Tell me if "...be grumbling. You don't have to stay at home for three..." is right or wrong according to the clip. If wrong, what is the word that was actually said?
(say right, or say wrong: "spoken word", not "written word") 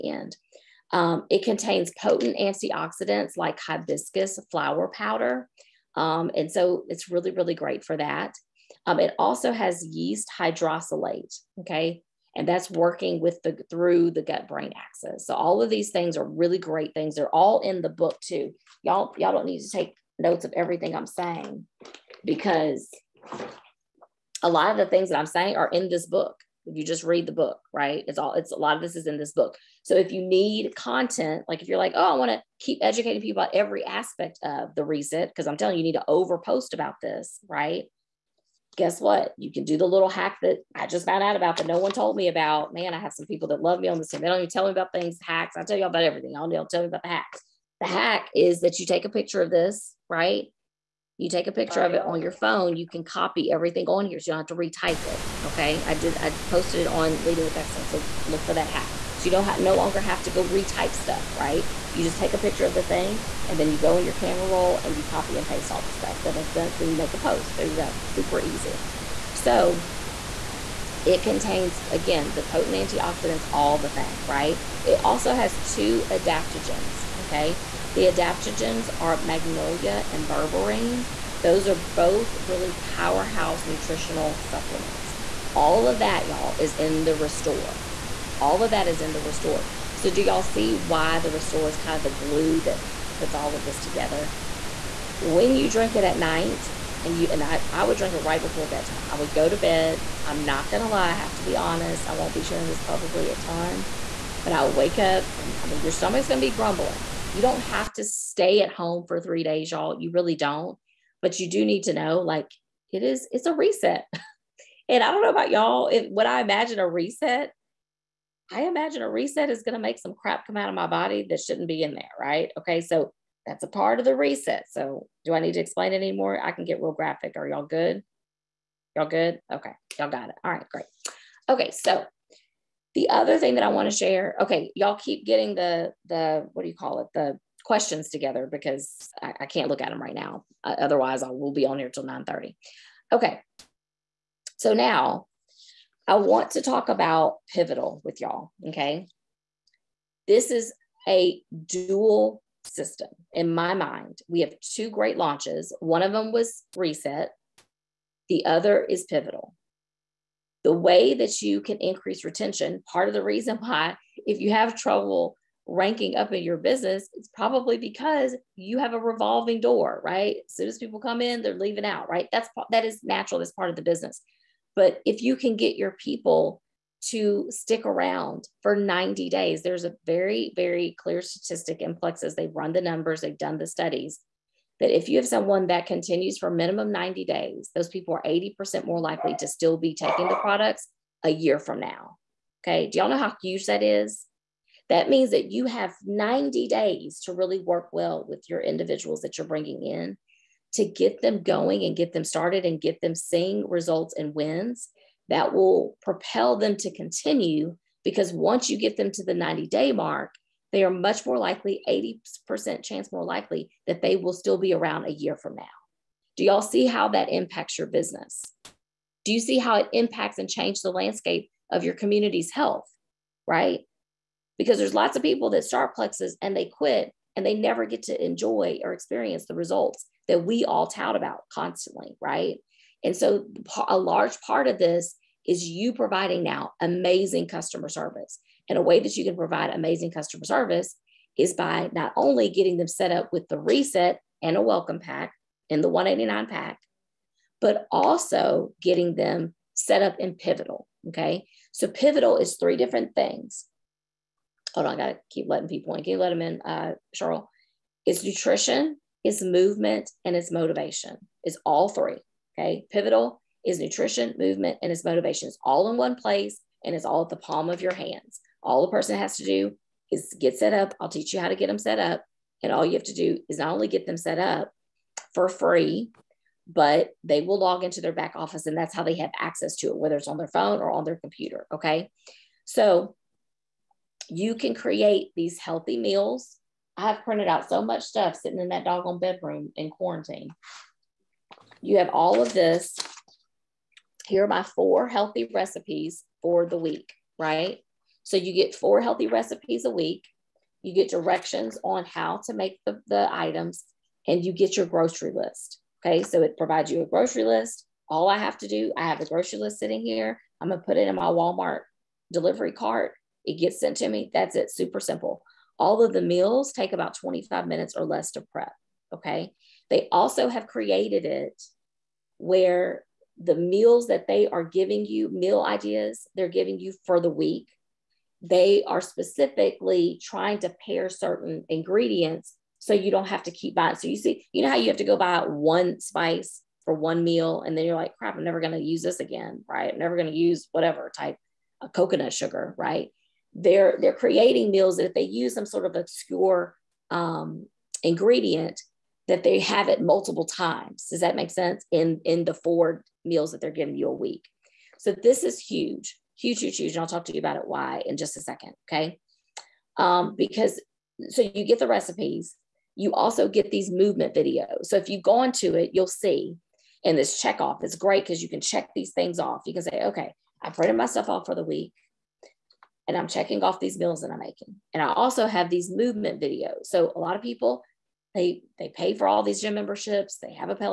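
right.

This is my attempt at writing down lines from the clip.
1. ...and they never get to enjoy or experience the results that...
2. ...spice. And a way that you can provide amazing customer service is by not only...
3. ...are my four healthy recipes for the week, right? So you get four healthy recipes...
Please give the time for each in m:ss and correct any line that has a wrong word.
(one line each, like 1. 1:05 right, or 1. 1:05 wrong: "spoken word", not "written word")
1. 3:47 right
2. 3:57 wrong: "service", not "spice"
3. 4:54 right.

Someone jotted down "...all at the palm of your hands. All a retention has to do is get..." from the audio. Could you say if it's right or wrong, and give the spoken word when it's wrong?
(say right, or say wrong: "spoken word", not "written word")
wrong: "person", not "retention".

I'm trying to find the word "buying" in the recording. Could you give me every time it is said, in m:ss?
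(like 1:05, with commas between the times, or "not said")
5:33.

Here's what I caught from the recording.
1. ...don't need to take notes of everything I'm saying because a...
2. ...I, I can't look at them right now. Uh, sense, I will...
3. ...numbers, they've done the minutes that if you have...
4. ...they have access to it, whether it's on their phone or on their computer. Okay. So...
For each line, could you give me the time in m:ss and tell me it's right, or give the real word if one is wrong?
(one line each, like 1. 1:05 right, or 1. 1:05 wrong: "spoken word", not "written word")
1. 0:19 right
2. 2:19 wrong: "otherwise", not "sense"
3. 3:02 wrong: "studies", not "minutes"
4. 4:39 right.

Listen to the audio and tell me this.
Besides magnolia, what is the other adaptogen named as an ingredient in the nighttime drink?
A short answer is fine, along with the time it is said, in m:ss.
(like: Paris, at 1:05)
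berberine, at 1:20.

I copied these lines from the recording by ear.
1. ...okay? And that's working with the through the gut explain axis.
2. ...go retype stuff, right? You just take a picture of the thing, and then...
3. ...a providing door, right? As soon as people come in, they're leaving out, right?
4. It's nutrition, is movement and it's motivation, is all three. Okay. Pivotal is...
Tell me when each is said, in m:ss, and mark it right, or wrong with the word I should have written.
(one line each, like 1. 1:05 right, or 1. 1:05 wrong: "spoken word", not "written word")
1. 0:11 wrong: "brain", not "explain"
2. 1:00 right
3. 2:48 wrong: "revolving", not "providing"
4. 4:18 right.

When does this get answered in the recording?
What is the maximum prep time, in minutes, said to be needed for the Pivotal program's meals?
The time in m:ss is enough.
5:17.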